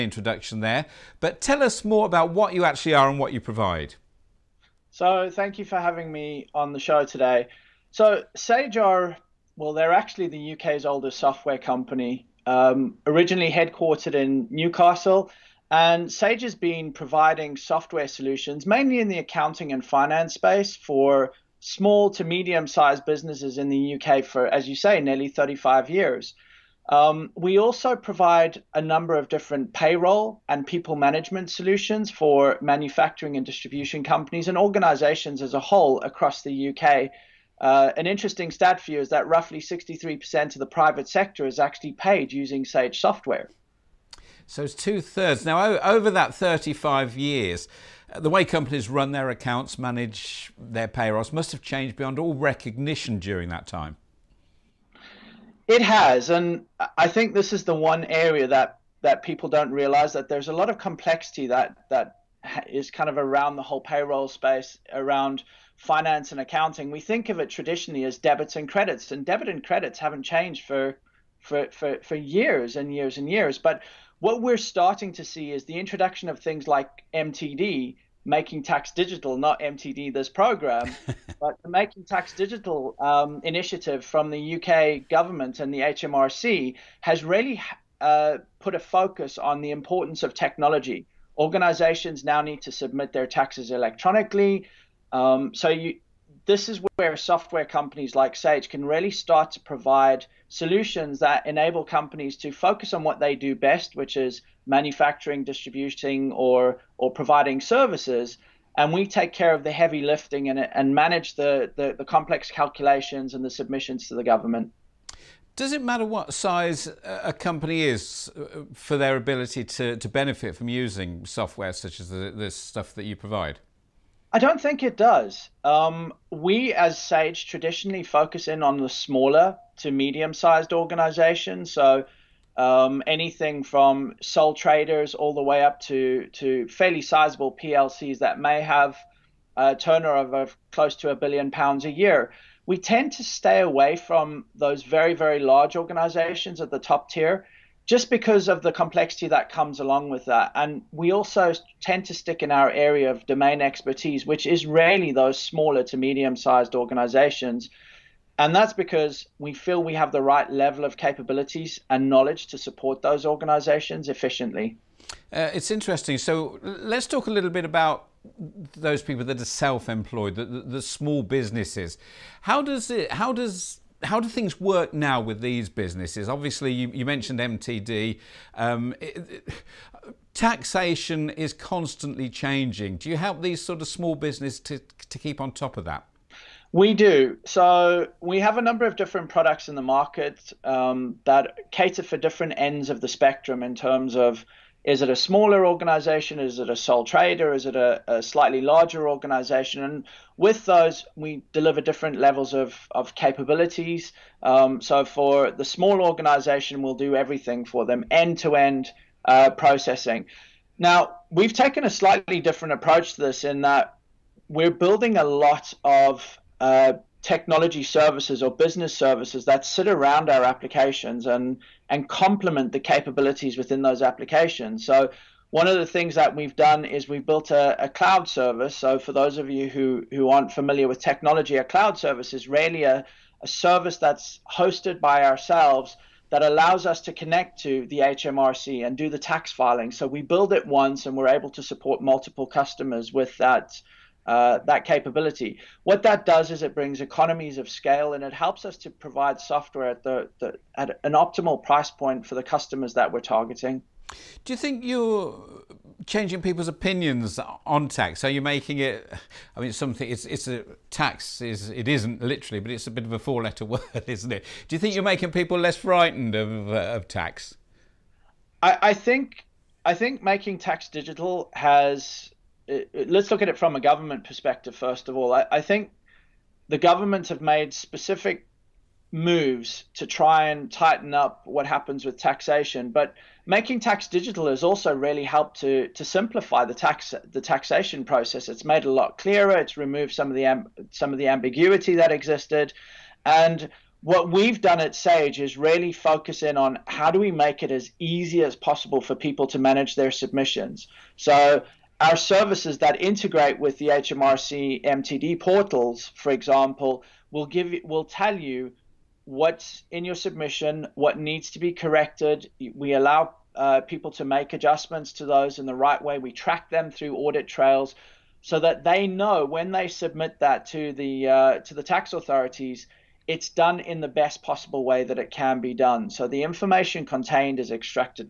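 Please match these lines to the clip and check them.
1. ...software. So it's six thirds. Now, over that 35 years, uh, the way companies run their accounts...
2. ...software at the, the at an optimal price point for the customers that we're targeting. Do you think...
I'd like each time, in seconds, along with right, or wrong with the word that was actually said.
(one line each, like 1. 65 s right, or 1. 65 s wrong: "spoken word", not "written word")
1. 42 s wrong: "two", not "six"
2. 249 s right.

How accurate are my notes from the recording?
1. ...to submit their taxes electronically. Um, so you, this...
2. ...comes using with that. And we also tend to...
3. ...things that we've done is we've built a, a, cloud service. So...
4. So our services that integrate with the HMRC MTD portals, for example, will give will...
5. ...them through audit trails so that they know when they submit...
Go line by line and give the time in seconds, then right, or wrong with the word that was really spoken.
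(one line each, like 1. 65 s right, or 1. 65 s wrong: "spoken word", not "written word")
1. 92 s right
2. 149 s wrong: "along", not "using"
3. 225 s right
4. 301 s right
5. 316 s right.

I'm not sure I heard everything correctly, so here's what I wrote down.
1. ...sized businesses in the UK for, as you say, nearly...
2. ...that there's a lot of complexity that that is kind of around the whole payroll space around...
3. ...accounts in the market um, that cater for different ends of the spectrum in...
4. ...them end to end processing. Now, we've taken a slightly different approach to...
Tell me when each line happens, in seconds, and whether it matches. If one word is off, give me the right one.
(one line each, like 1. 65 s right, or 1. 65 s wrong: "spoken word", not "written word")
1. 22 s right
2. 60 s right
3. 189 s wrong: "products", not "accounts"
4. 207 s right.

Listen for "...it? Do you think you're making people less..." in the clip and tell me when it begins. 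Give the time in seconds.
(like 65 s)
264 s.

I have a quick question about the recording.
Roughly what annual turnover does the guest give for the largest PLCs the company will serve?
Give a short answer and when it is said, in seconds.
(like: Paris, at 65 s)
close to a billion pounds, at 140 s.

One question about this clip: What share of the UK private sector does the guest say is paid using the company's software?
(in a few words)
63%.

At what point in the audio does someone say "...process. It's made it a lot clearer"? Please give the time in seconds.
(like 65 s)
288 s.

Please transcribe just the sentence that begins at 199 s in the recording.
And with those, we deliver different levels of, of capabilities.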